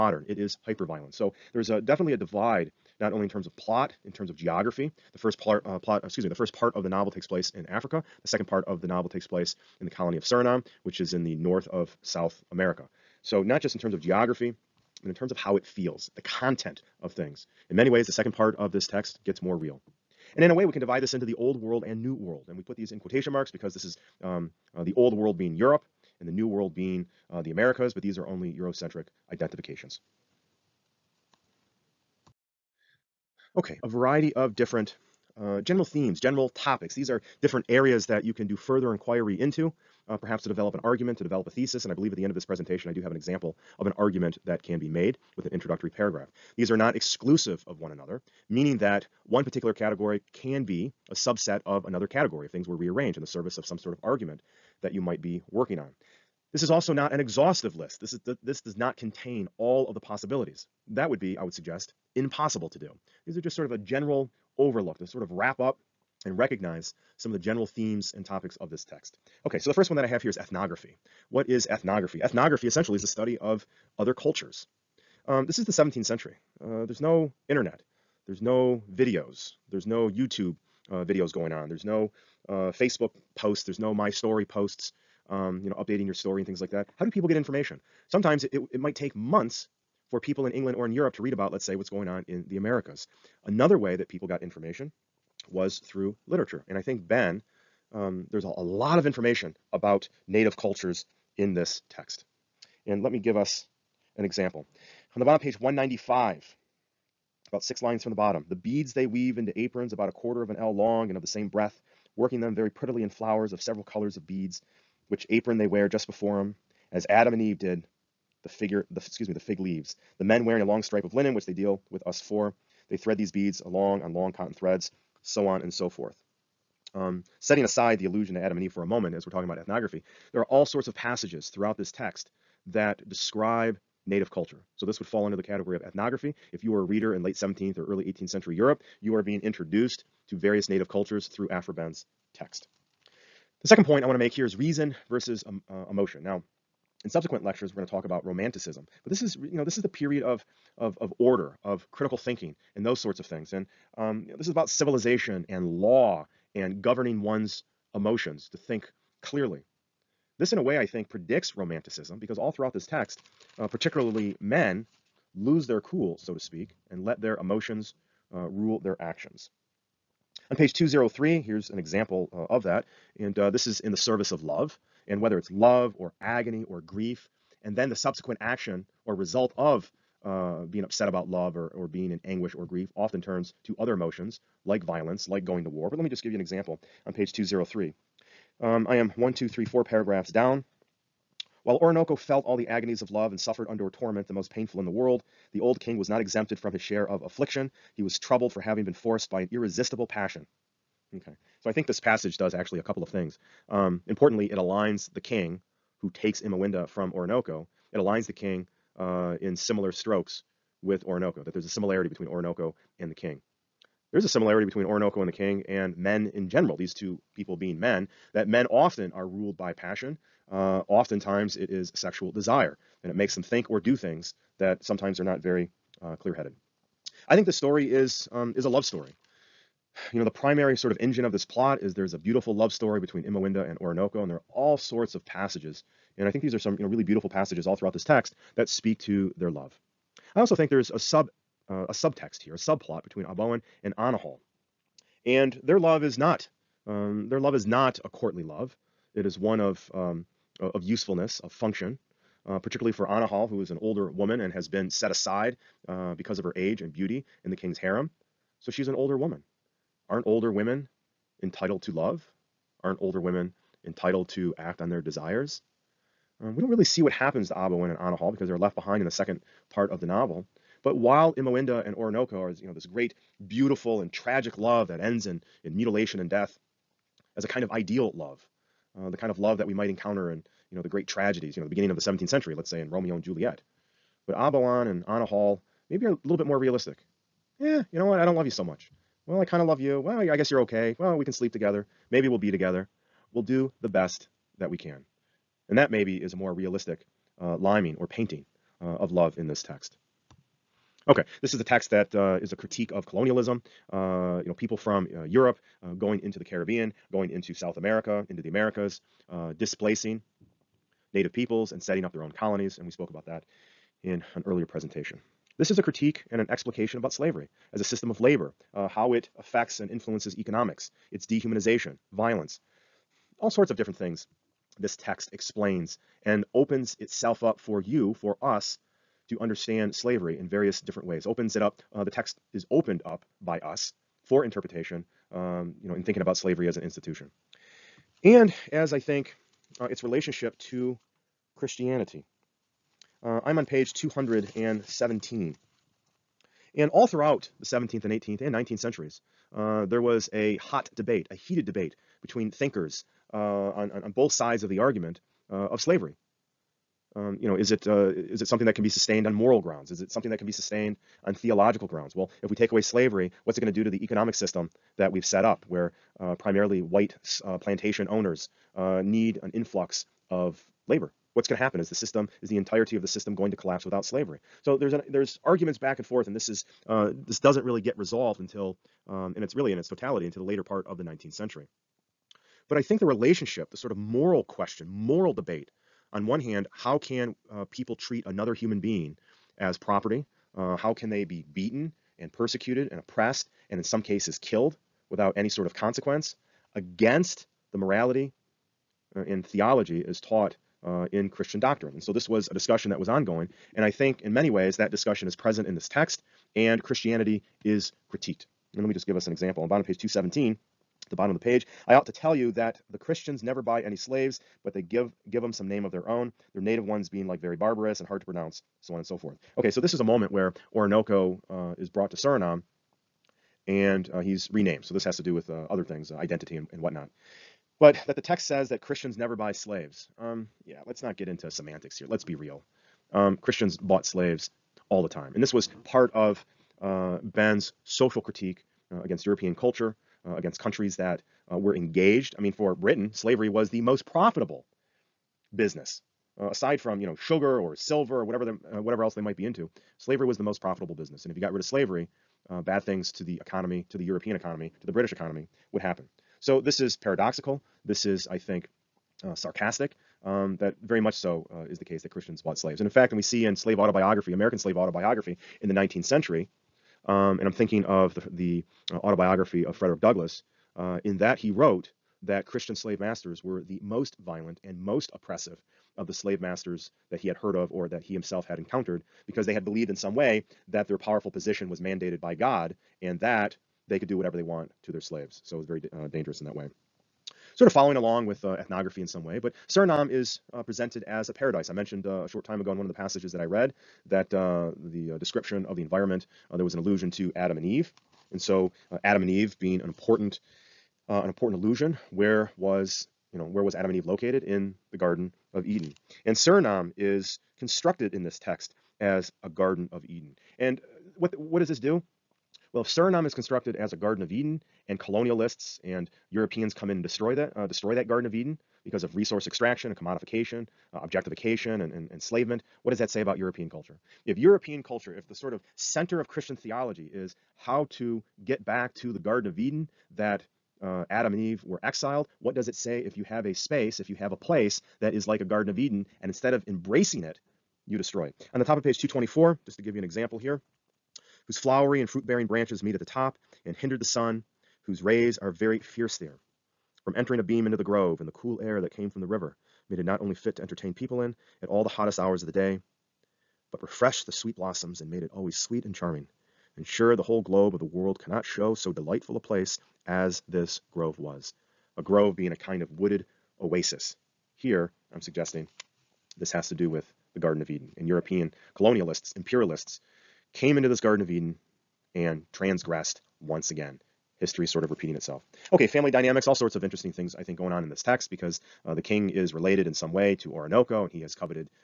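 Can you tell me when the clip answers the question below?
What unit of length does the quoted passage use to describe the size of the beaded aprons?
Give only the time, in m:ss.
1:50.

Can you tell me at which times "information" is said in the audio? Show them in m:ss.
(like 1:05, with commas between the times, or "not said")
1:27, 1:34, 1:39.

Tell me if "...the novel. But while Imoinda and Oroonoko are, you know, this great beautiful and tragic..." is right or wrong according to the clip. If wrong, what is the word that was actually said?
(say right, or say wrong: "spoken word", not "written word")
right.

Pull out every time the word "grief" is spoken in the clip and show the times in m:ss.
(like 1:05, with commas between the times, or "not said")
2:56, 3:02.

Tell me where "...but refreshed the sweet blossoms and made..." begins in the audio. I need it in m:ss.
9:13.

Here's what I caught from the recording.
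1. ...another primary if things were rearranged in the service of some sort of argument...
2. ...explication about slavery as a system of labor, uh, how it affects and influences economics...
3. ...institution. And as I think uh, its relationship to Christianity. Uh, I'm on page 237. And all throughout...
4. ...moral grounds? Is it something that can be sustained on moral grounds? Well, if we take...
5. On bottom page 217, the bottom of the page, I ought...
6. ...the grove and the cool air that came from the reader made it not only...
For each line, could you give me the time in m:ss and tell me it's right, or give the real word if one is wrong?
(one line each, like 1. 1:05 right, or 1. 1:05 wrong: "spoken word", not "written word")
1. 0:51 wrong: "category", not "primary"
2. 5:16 right
3. 5:36 wrong: "217", not "237"
4. 5:59 wrong: "theological", not "moral"
5. 6:49 right
6. 9:07 wrong: "river", not "reader".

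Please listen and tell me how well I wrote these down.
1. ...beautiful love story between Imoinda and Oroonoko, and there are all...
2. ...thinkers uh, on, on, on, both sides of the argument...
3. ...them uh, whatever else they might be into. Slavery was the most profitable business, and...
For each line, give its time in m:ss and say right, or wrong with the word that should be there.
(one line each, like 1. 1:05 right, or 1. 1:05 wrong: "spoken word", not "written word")
1. 3:52 right
2. 5:52 right
3. 7:28 right.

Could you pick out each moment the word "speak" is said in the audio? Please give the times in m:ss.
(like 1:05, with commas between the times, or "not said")
2:46, 3:58.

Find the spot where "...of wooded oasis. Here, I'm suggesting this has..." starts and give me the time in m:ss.
9:22.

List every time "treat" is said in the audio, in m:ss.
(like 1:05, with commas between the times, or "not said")
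6:27.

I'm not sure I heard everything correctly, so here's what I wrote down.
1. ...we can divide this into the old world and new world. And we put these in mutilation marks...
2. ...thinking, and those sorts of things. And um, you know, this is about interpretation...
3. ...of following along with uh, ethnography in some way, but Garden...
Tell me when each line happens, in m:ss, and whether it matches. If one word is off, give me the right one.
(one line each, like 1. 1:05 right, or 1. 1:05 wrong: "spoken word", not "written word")
1. 0:20 wrong: "quotation", not "mutilation"
2. 2:32 wrong: "civilization", not "interpretation"
3. 8:07 wrong: "Suriname", not "Garden".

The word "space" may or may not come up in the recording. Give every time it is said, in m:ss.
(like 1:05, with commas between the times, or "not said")
8:53.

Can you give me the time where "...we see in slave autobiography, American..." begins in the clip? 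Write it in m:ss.
7:43.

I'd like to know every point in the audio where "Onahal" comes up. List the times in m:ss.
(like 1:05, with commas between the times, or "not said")
4:03, 4:13, 4:27, 4:45.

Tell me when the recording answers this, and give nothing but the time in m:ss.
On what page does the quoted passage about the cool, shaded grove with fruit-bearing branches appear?
8:58.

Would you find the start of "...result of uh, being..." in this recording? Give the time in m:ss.
2:59.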